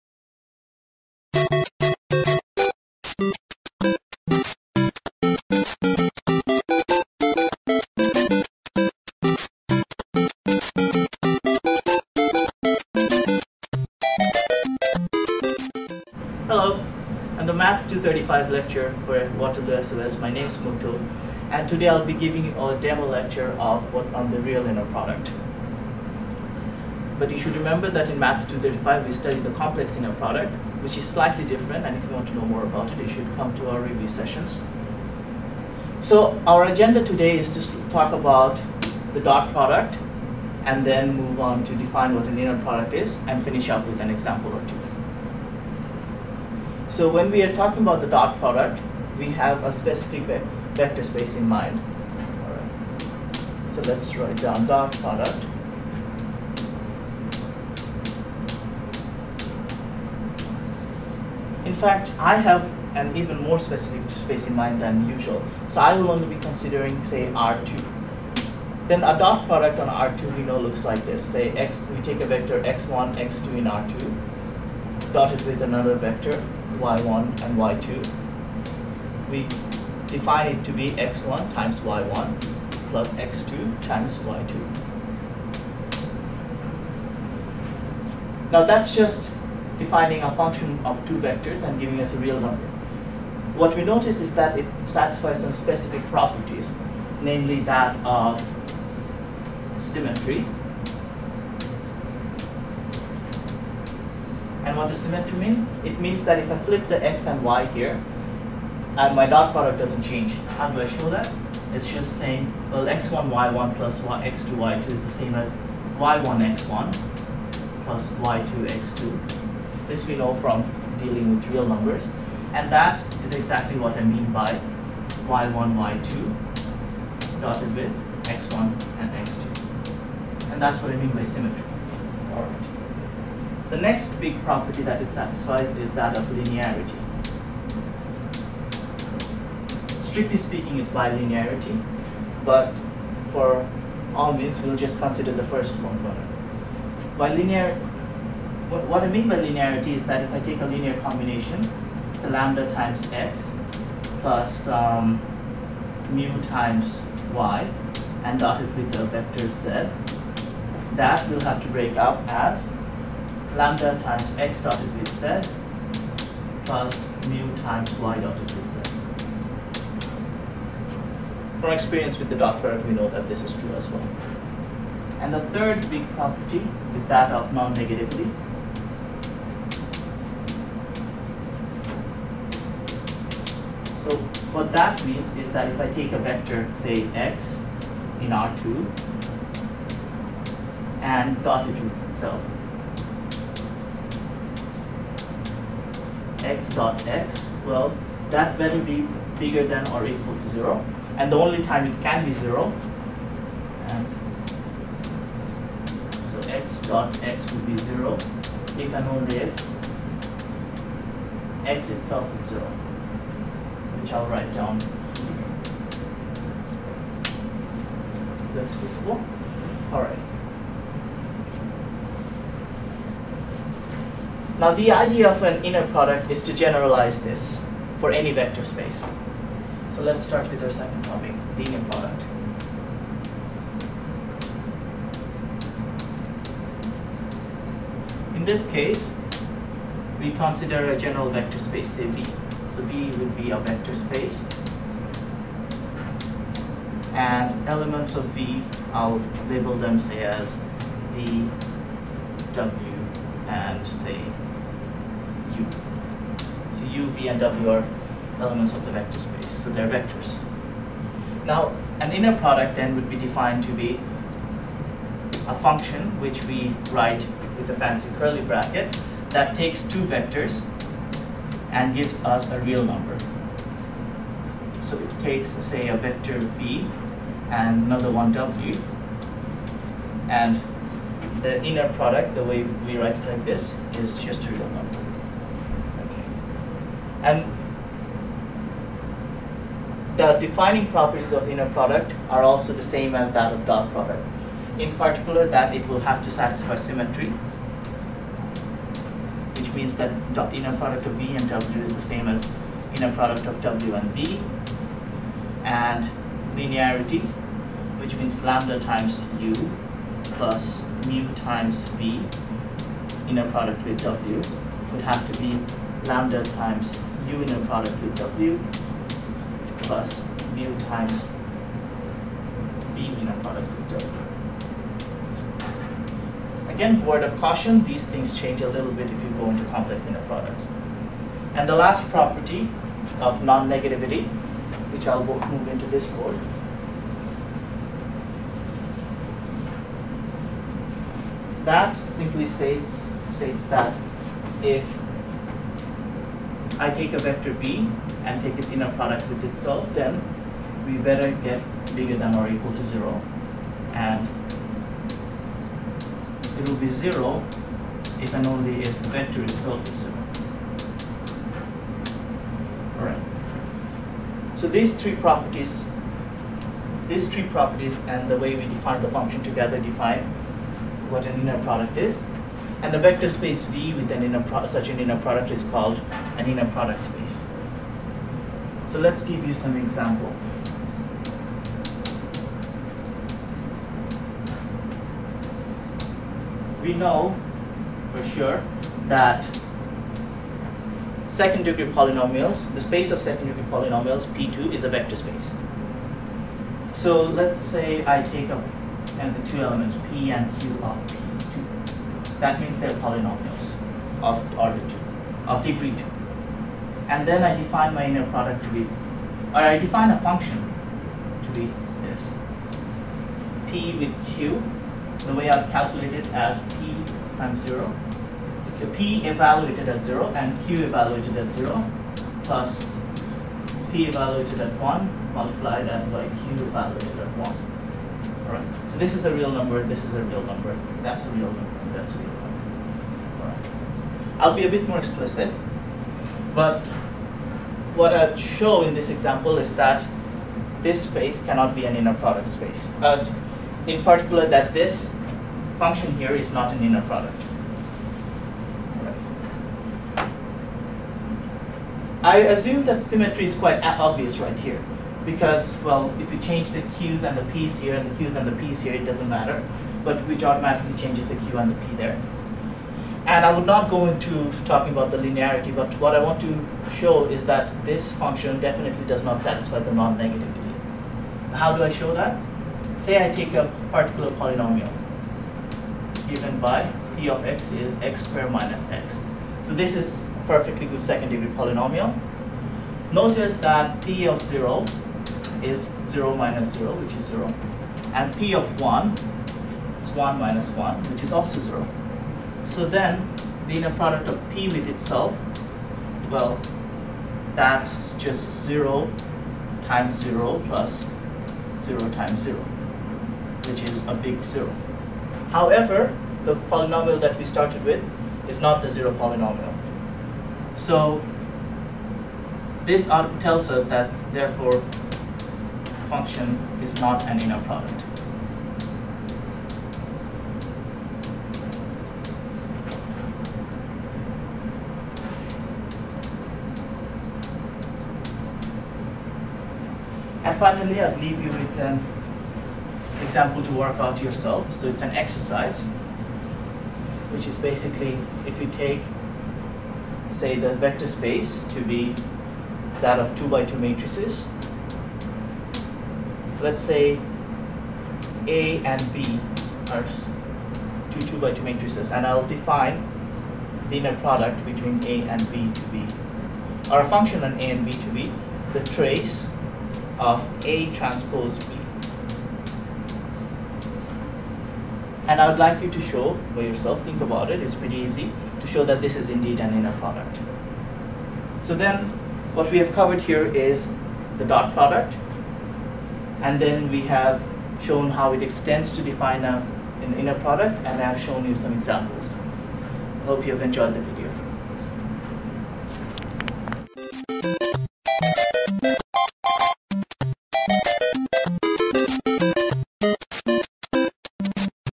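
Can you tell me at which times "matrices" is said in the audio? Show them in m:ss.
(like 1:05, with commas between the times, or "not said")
9:03, 9:11.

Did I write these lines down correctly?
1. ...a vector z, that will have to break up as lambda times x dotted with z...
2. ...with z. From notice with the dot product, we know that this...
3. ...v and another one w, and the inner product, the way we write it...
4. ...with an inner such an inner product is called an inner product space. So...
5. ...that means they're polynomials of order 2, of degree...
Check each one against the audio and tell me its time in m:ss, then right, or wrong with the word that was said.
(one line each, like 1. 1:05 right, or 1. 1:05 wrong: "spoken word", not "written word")
1. 2:38 right
2. 2:48 wrong: "experience", not "notice"
3. 4:36 right
4. 6:13 right
5. 6:42 right.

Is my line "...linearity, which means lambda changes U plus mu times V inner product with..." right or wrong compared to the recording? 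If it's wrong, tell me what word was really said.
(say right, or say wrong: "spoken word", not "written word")
wrong: "times", not "changes".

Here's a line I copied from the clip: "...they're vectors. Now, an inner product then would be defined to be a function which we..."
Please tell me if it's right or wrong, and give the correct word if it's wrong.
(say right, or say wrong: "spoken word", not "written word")
right.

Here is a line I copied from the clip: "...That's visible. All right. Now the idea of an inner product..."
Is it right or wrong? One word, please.
right.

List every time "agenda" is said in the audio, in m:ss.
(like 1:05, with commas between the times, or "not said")
0:36.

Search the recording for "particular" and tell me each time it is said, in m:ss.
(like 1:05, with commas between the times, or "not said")
4:54, 7:24, 7:53.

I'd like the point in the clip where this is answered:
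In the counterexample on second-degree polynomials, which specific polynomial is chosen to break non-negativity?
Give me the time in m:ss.
7:57.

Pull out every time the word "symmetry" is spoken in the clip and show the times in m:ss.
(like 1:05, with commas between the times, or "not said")
1:39, 1:44, 2:11, 4:56, 7:33.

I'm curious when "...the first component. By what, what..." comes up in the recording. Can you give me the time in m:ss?
2:25.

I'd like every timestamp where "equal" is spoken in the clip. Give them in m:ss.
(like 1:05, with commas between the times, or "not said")
3:20, 5:52.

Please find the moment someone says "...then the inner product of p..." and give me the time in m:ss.
8:12.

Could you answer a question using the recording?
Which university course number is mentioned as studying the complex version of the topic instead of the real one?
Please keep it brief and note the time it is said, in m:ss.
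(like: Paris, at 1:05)
Math 235, at 0:28.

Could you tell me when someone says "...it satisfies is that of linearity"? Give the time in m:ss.
2:15.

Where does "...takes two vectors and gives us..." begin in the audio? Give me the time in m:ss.
4:29.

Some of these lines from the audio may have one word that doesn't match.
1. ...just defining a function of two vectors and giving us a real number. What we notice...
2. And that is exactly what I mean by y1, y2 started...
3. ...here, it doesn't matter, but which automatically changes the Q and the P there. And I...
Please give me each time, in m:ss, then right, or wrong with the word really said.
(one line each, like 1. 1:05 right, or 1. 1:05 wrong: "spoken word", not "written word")
1. 1:28 right
2. 2:02 wrong: "dotted", not "started"
3. 7:38 right.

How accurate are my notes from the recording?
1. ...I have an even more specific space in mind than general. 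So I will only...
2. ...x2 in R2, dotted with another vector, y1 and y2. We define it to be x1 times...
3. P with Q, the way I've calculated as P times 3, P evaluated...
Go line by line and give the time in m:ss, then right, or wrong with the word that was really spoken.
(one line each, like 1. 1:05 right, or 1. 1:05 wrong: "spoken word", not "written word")
1. 1:02 wrong: "usual", not "general"
2. 1:13 right
3. 6:53 wrong: "0", not "3".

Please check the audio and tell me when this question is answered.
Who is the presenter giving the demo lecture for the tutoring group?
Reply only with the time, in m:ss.
0:20.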